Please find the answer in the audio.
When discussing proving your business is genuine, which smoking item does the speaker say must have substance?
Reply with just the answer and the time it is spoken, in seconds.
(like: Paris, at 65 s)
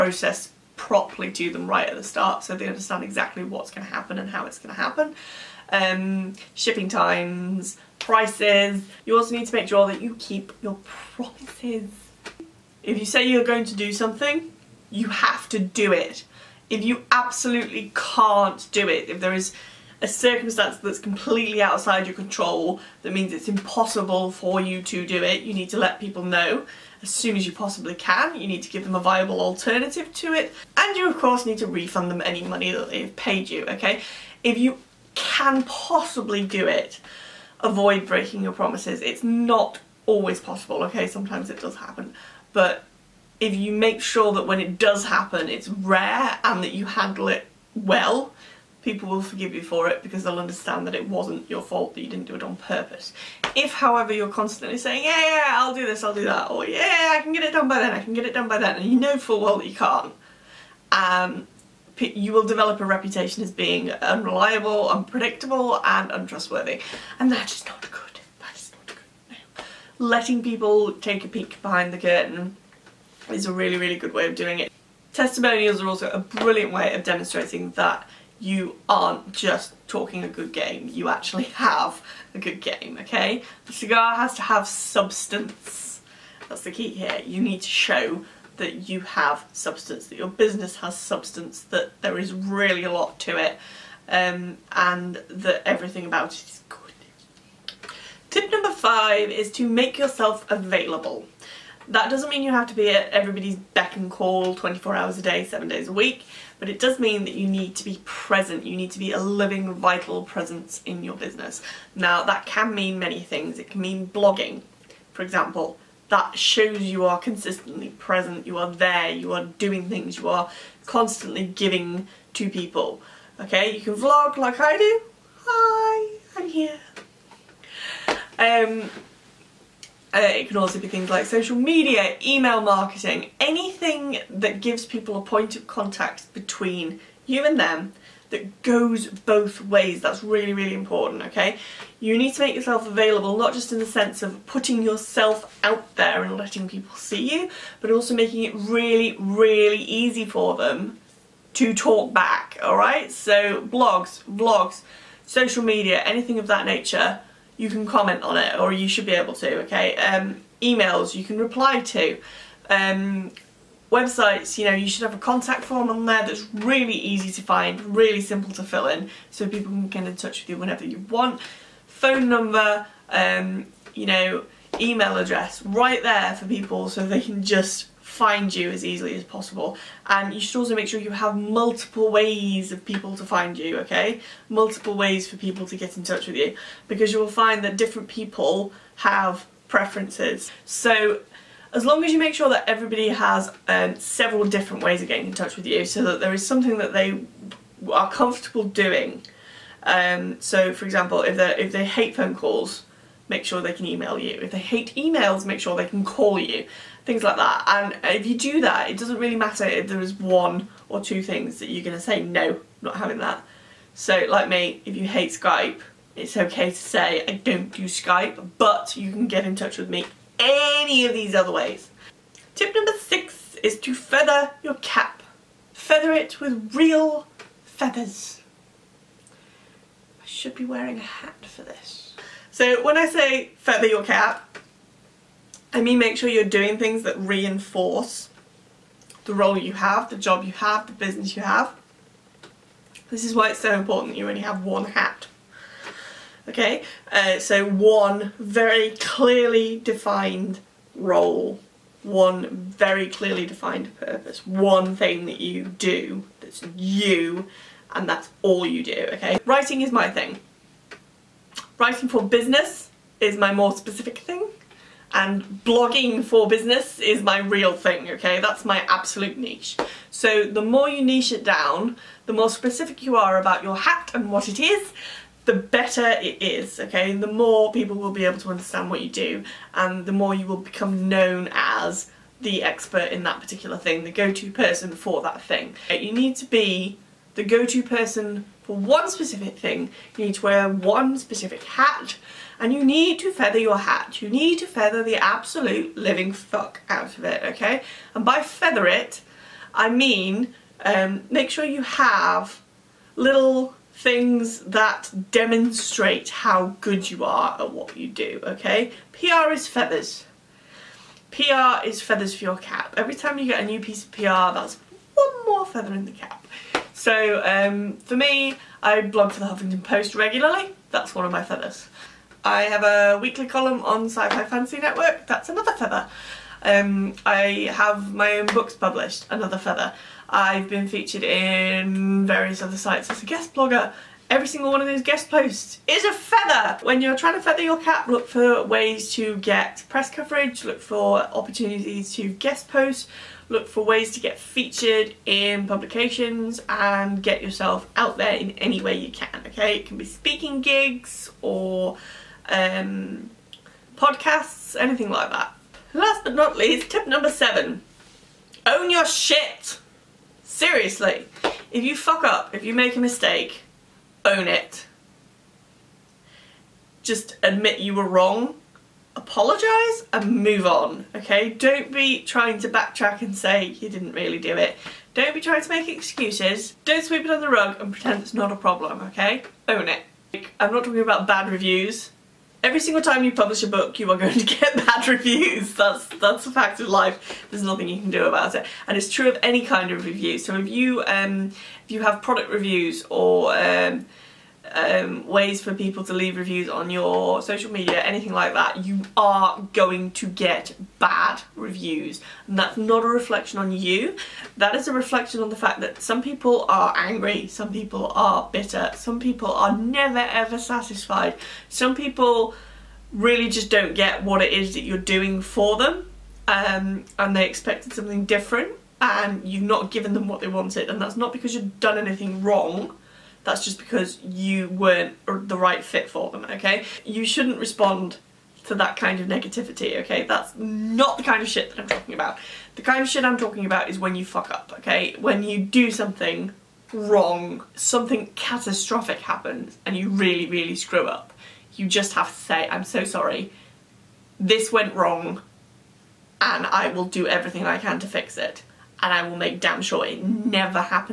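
cigar, at 83 s.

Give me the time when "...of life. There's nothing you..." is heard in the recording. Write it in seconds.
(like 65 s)
386 s.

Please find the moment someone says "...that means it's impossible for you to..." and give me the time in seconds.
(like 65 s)
23 s.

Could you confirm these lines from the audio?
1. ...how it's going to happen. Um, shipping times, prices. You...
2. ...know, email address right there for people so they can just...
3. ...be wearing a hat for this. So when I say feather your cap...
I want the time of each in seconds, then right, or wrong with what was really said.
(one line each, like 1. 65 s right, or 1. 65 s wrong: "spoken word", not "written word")
1. 4 s right
2. 174 s right
3. 230 s right.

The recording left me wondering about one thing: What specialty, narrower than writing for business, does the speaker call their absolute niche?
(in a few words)
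blogging for business.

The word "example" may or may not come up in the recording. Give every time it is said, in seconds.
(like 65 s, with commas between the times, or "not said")
115 s, 200 s.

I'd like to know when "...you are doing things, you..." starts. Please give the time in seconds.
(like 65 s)
119 s.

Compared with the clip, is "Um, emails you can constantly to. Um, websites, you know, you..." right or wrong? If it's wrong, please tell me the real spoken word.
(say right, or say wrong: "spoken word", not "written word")
wrong: "reply", not "constantly".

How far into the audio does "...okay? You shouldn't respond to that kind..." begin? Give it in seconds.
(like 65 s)
426 s.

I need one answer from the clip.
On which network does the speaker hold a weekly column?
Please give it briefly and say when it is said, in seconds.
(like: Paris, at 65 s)
Sci-Fi Fantasy Network, at 324 s.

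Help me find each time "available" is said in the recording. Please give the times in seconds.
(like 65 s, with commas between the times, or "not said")
100 s, 142 s.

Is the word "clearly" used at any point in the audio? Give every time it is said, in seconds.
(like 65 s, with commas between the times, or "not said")
249 s, 253 s.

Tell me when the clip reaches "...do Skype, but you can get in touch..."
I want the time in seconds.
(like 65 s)
217 s.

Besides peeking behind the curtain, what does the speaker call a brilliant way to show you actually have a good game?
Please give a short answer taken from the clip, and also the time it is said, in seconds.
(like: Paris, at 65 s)
Testimonials, at 75 s.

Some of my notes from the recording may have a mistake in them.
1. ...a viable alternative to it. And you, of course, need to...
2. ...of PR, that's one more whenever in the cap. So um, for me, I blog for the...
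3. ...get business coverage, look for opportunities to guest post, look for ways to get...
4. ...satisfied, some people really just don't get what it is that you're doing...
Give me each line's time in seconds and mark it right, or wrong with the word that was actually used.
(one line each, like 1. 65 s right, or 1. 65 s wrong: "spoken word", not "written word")
1. 28 s right
2. 314 s wrong: "feather", not "whenever"
3. 339 s wrong: "press", not "business"
4. 410 s right.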